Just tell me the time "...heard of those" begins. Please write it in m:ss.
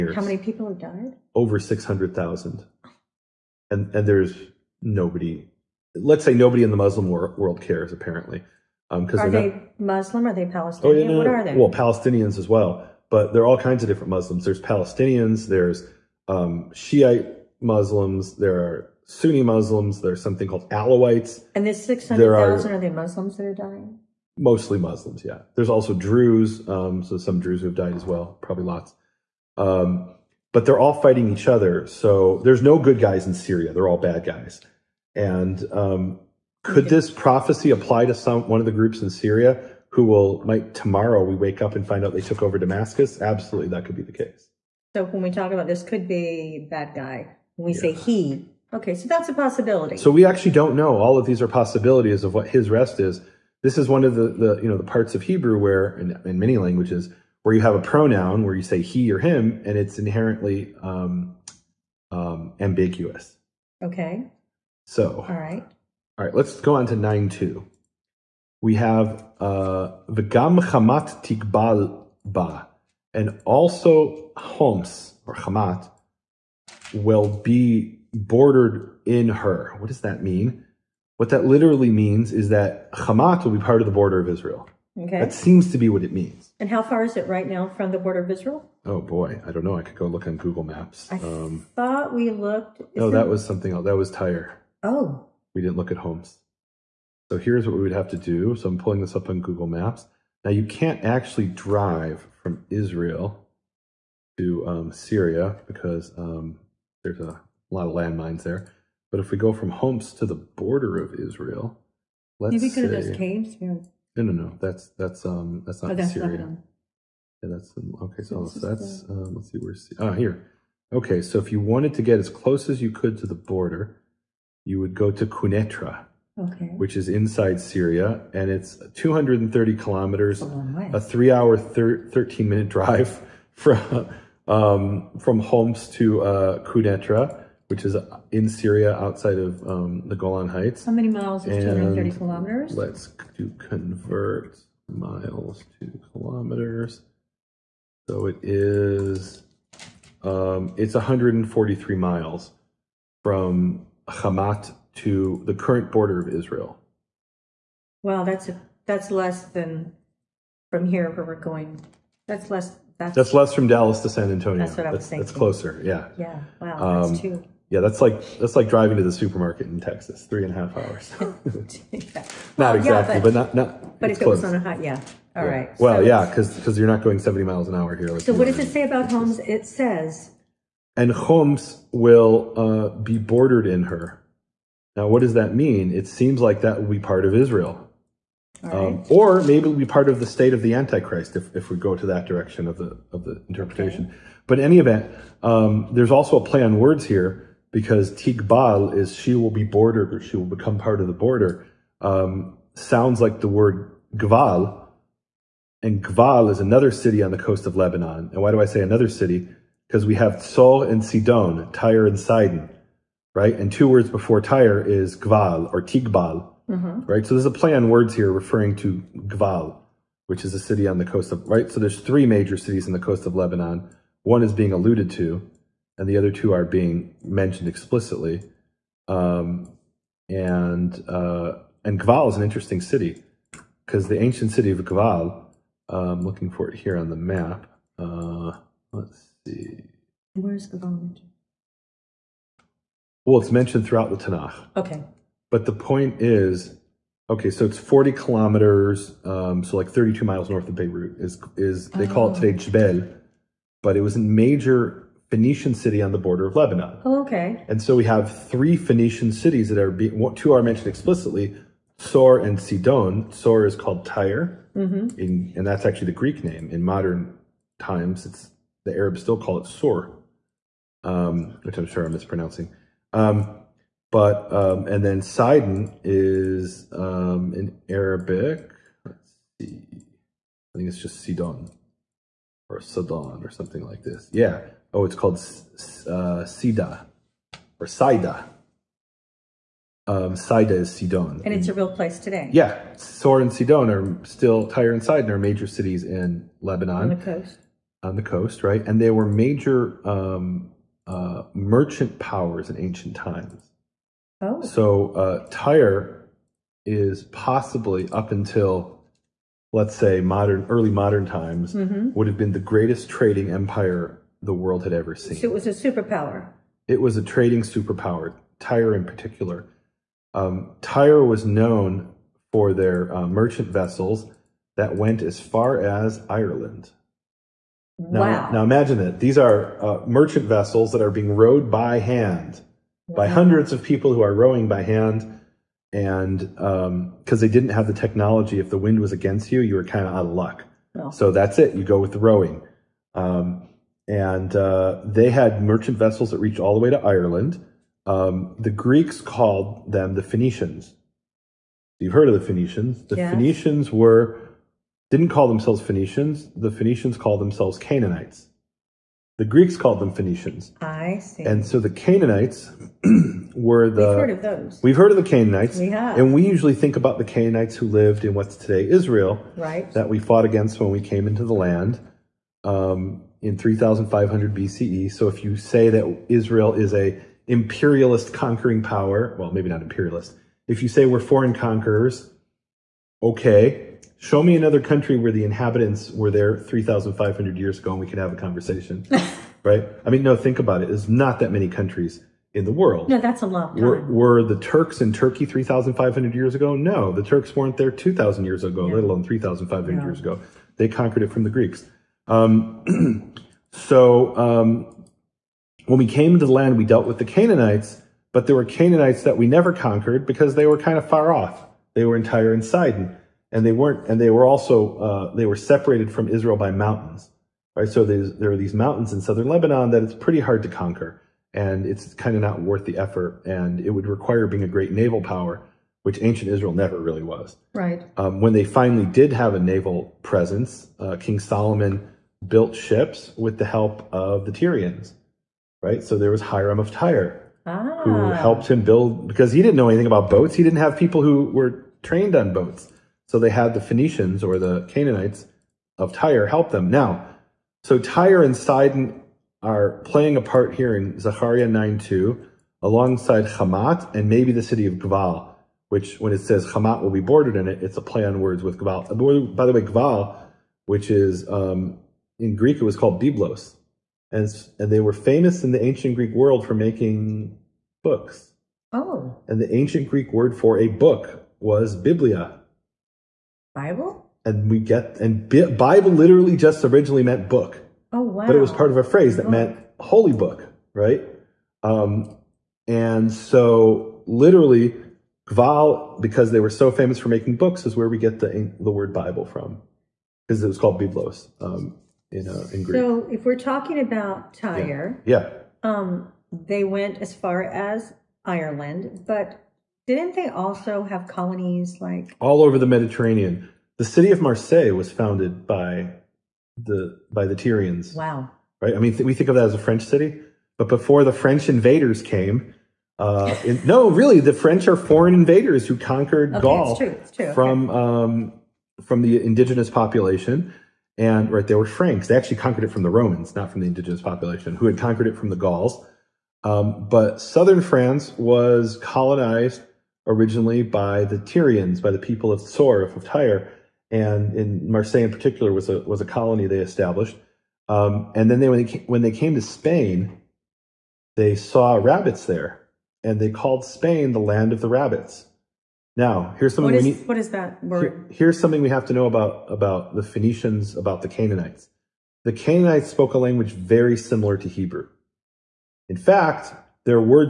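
6:04.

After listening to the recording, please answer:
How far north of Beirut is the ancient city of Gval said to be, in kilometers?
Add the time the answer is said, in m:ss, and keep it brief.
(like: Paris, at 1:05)
40 kilometers, at 4:07.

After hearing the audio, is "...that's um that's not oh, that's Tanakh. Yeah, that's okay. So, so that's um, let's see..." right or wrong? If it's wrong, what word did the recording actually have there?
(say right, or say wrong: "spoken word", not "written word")
wrong: "Syria", not "Tanakh".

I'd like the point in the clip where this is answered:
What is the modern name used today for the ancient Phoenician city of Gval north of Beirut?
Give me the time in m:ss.
4:12.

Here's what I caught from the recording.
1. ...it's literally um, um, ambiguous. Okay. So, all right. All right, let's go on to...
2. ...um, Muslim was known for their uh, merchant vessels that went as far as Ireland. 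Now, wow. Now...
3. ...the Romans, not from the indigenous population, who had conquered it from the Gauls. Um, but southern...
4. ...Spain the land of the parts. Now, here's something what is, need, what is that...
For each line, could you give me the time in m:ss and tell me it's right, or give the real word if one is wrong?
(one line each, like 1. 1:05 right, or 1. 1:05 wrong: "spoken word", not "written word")
1. 0:59 wrong: "inherently", not "literally"
2. 5:20 wrong: "Tyre", not "Muslim"
3. 8:43 right
4. 9:03 wrong: "rabbits", not "parts".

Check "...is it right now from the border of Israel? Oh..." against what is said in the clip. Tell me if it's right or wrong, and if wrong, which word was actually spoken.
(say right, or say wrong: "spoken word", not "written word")
right.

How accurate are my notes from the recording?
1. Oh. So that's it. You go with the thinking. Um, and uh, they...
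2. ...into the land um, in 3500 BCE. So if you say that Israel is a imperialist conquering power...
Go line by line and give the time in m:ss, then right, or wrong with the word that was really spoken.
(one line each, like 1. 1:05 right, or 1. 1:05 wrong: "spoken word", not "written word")
1. 5:40 wrong: "rowing", not "thinking"
2. 6:11 right.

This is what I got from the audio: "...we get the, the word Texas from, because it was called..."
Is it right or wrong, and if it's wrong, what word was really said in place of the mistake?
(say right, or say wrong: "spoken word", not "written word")
wrong: "Bible", not "Texas".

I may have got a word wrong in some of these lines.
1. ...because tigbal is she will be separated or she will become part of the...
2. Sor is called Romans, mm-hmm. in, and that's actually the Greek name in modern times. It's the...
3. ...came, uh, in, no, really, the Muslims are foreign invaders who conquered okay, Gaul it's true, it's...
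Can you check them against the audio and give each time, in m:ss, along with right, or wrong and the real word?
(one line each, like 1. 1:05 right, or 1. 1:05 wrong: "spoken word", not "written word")
1. 3:17 wrong: "bordered", not "separated"
2. 4:23 wrong: "Tyre", not "Romans"
3. 8:32 wrong: "French", not "Muslims".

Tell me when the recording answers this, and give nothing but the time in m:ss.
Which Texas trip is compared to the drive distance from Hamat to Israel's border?
2:43.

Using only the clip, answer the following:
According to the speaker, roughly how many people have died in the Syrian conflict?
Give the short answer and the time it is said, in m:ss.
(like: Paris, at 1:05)
Over 600,000, at 0:01.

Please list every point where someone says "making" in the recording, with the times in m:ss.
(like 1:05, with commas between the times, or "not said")
7:46, 8:07.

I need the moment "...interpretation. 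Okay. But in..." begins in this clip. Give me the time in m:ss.
3:13.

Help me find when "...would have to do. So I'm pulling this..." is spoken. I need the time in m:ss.
1:37.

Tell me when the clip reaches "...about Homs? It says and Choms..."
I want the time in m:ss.
2:58.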